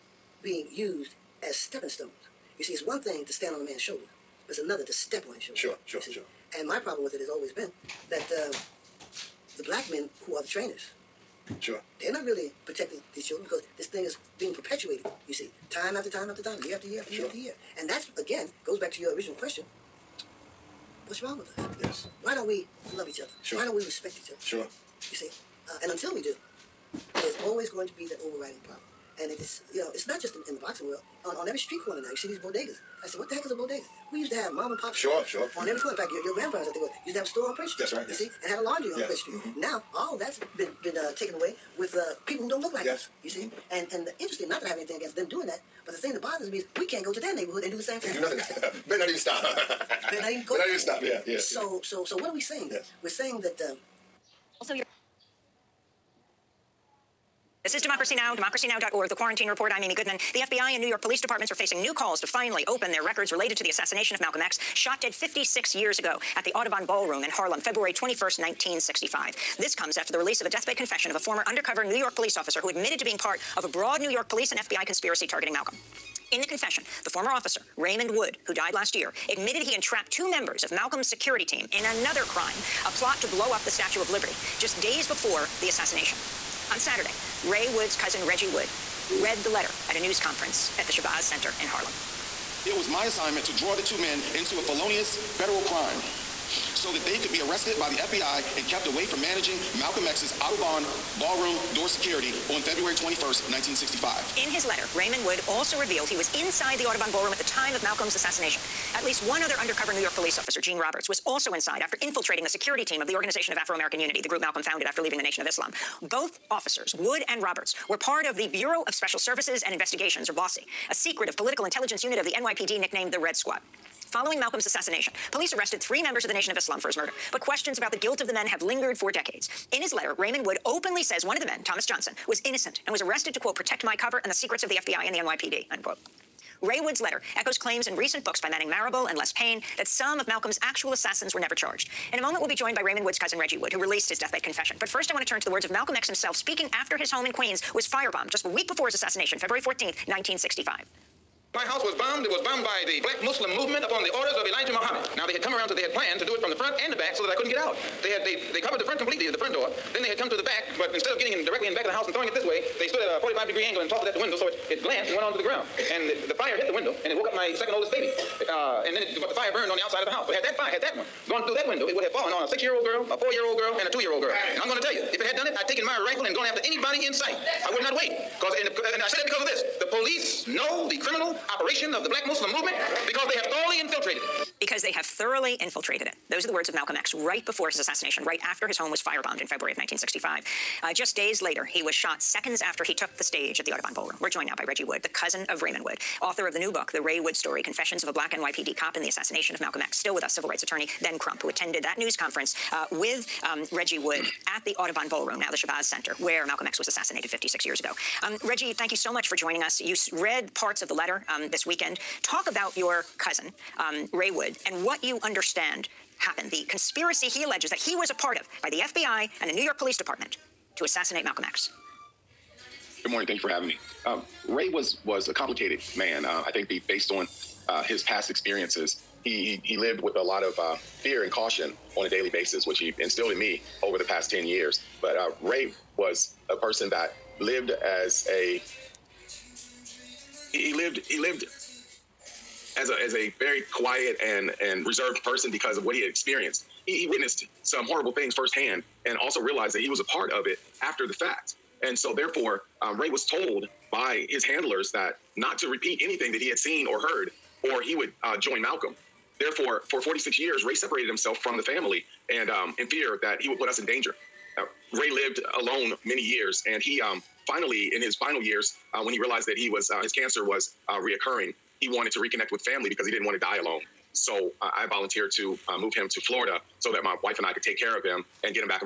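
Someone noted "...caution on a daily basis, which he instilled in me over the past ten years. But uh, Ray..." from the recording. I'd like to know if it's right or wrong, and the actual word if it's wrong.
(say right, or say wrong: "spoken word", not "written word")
right.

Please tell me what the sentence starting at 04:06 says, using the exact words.
He, he, witnessed some horrible things firsthand, and also realized that he was a part of it after the fact.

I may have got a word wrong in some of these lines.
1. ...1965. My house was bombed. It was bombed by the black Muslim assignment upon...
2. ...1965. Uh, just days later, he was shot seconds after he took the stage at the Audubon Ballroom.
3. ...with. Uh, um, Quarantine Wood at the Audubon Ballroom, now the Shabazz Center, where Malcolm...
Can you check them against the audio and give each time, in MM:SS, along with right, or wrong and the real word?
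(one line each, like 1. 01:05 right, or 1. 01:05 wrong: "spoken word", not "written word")
1. 02:30 wrong: "movement", not "assignment"
2. 03:09 right
3. 03:22 wrong: "Reggie", not "Quarantine".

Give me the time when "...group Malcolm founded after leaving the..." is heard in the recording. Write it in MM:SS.
01:54.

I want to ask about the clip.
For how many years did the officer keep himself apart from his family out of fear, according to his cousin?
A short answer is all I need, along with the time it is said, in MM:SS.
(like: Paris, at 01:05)
46, at 04:20.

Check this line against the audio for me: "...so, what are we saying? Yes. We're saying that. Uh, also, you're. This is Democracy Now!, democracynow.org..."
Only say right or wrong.
right.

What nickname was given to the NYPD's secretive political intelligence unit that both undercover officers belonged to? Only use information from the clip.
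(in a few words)
the Red Squad.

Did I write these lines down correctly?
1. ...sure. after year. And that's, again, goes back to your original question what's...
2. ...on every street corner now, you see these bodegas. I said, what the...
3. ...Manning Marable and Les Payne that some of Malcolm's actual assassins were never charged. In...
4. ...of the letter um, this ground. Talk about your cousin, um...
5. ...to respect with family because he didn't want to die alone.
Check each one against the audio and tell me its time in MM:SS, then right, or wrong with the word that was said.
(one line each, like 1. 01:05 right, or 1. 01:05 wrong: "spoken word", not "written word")
1. 00:17 right
2. 00:31 right
3. 02:18 right
4. 03:30 wrong: "weekend", not "ground"
5. 04:32 wrong: "reconnect", not "respect".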